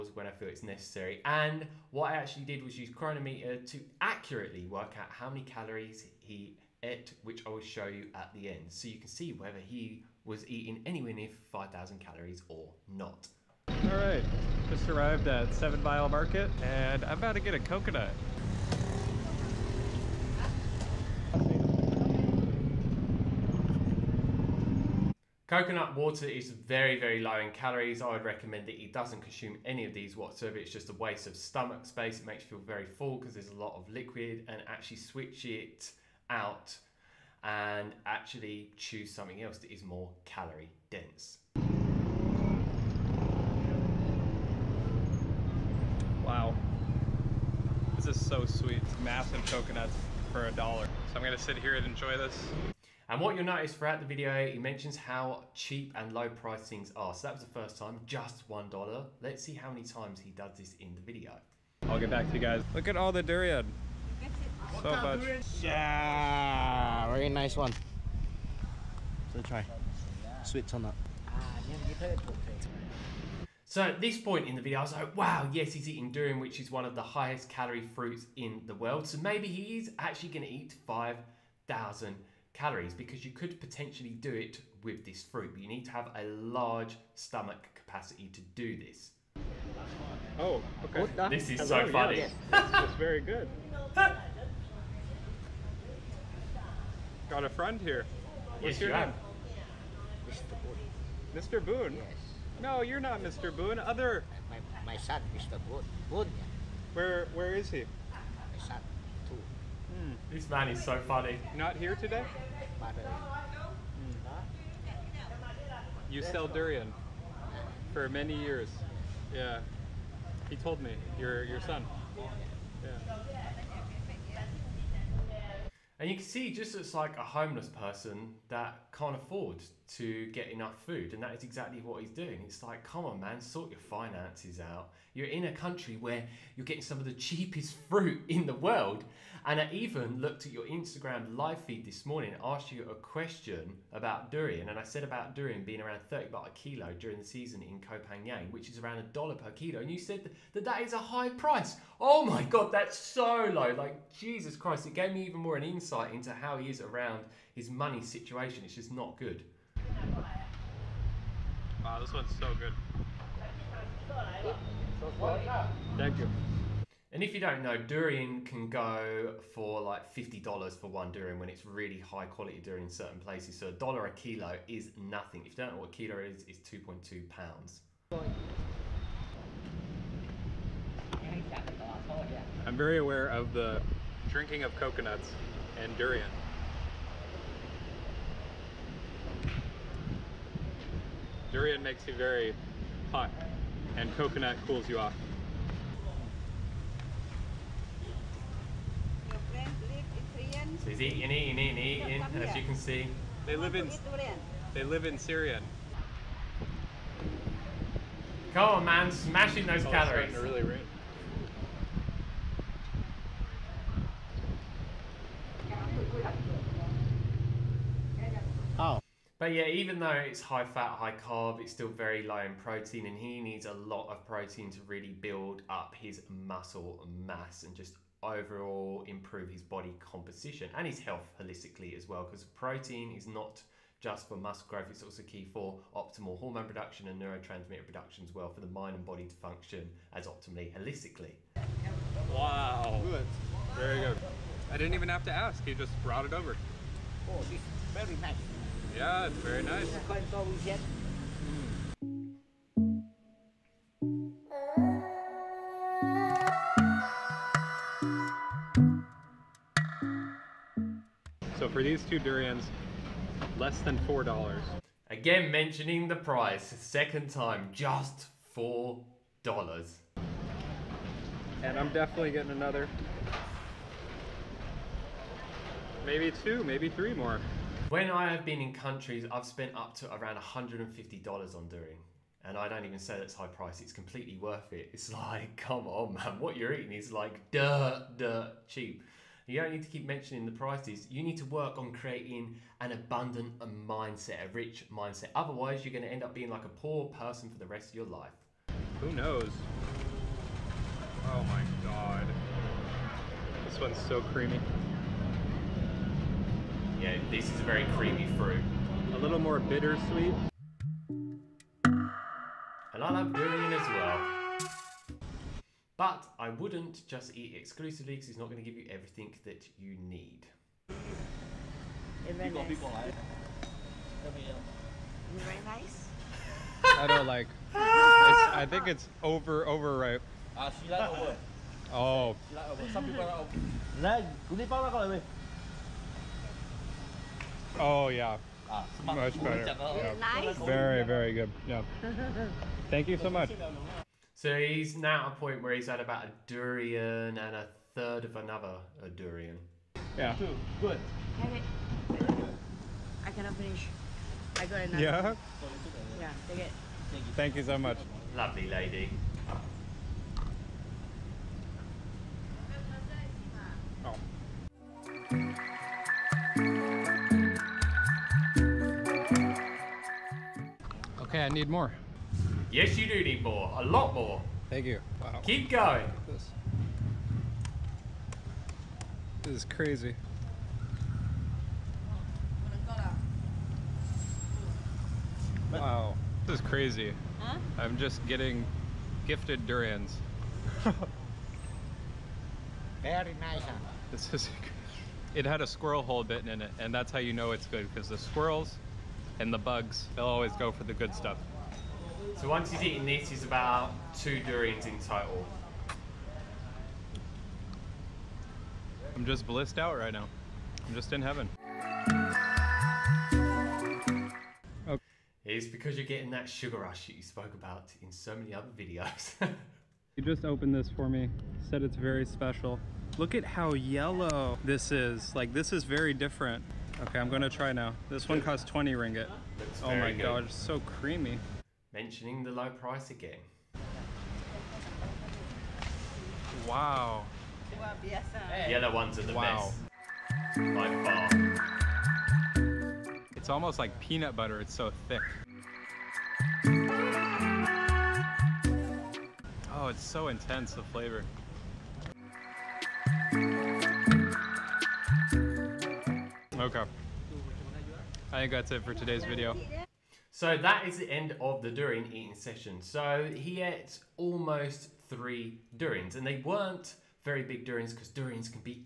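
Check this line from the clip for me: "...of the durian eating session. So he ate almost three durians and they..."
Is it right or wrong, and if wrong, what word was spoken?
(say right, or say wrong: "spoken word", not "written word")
right.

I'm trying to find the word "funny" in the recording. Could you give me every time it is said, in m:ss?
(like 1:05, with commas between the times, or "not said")
1:31, 1:51.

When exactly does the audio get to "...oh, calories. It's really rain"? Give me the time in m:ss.
3:29.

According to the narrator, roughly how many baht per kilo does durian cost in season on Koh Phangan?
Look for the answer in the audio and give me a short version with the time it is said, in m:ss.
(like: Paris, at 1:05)
30 baht, at 2:26.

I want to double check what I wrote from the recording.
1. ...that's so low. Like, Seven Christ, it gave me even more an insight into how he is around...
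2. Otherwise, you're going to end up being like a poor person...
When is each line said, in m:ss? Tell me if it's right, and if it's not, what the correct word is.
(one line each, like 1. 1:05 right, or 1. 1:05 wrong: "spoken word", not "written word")
1. 2:32 wrong: "Jesus", not "Seven"
2. 4:55 right.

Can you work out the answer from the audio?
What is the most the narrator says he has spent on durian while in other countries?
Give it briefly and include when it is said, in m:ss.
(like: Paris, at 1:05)
$150, at 4:40.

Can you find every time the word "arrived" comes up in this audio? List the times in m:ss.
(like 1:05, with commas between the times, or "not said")
0:14.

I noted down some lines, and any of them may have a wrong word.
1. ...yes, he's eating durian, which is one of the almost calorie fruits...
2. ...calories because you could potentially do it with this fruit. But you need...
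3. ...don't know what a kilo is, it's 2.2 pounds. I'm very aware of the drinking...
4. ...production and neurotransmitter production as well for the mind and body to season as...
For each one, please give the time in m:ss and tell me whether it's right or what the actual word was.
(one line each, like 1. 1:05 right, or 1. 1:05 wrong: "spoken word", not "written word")
1. 1:15 wrong: "highest", not "almost"
2. 1:22 right
3. 2:55 right
4. 3:56 wrong: "function", not "season".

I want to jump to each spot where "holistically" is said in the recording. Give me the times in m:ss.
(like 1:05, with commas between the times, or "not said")
3:51, 4:00.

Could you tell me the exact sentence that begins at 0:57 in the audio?
So that was the first time, just $1.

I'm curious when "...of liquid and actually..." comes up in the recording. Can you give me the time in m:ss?
0:33.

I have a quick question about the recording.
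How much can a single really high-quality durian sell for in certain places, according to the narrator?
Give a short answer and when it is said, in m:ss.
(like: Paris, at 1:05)
$50, at 2:50.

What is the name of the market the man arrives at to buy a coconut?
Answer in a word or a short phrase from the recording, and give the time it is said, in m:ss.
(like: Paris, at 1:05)
Seven Mile Market, at 0:15.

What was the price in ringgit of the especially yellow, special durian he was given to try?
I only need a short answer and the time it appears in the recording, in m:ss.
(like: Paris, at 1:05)
20 ringgit, at 7:08.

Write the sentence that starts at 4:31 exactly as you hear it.
And I'm definitely getting another, maybe two, maybe three more.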